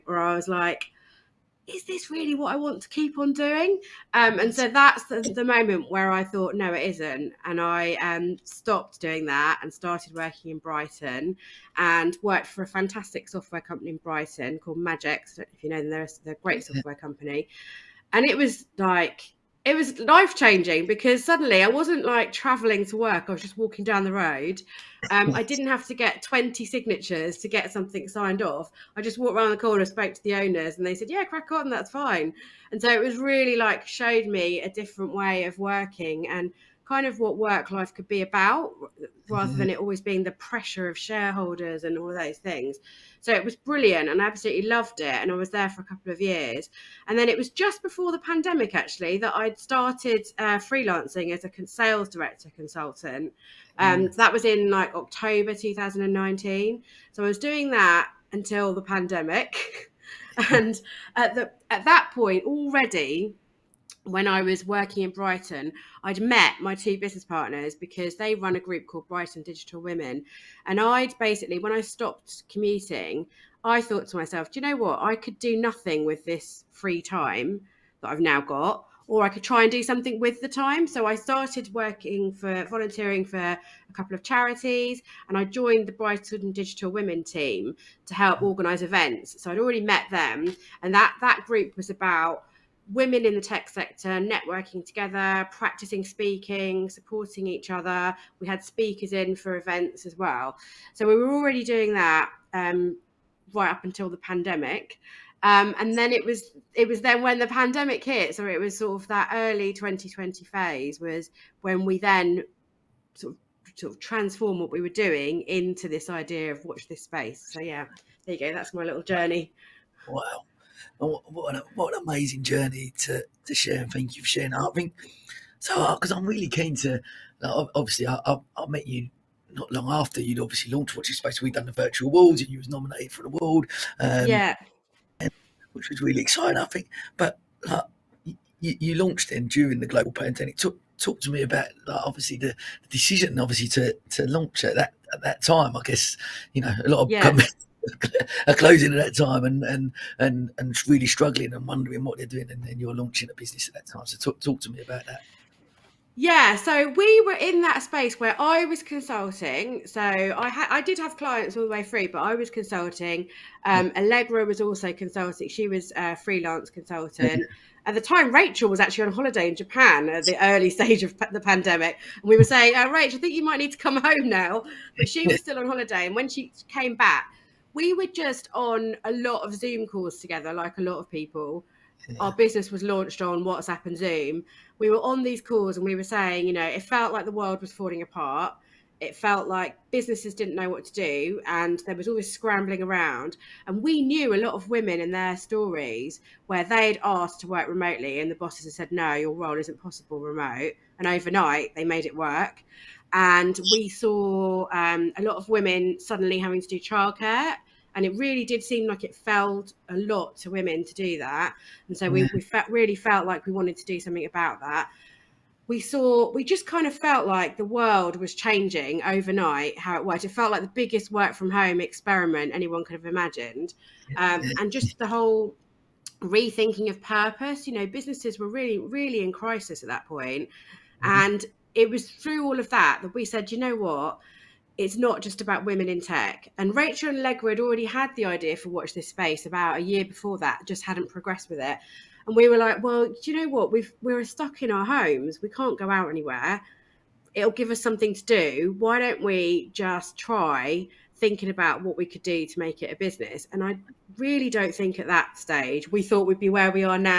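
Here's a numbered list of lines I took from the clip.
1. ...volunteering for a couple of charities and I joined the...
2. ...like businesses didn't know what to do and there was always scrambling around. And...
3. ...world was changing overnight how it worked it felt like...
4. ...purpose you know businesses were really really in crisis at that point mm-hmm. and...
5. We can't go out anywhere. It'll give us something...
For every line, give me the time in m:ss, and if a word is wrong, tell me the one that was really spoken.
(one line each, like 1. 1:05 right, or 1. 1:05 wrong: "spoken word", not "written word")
1. 1:22 right
2. 3:09 right
3. 3:37 right
4. 3:47 right
5. 4:05 right.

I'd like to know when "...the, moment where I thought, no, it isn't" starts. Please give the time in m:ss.
0:05.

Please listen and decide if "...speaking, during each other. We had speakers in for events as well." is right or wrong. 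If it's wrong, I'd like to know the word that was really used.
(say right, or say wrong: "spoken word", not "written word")
wrong: "supporting", not "during".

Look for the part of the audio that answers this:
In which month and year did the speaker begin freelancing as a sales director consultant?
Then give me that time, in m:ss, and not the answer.
0:54.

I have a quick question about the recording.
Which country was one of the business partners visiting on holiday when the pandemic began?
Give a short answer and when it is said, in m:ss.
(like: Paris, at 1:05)
Japan, at 2:49.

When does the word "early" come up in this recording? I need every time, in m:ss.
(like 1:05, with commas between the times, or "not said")
1:49, 2:50.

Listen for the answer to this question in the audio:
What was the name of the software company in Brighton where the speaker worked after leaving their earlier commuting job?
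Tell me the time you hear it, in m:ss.
0:14.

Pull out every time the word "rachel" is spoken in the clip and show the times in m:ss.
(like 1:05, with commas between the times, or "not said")
2:48, 2:52, 3:56.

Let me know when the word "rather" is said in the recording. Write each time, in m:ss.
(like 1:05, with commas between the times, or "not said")
0:39.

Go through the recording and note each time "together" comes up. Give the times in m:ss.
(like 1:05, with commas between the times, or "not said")
1:34, 3:00.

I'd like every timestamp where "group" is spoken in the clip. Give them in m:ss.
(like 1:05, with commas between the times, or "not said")
1:08, 1:31.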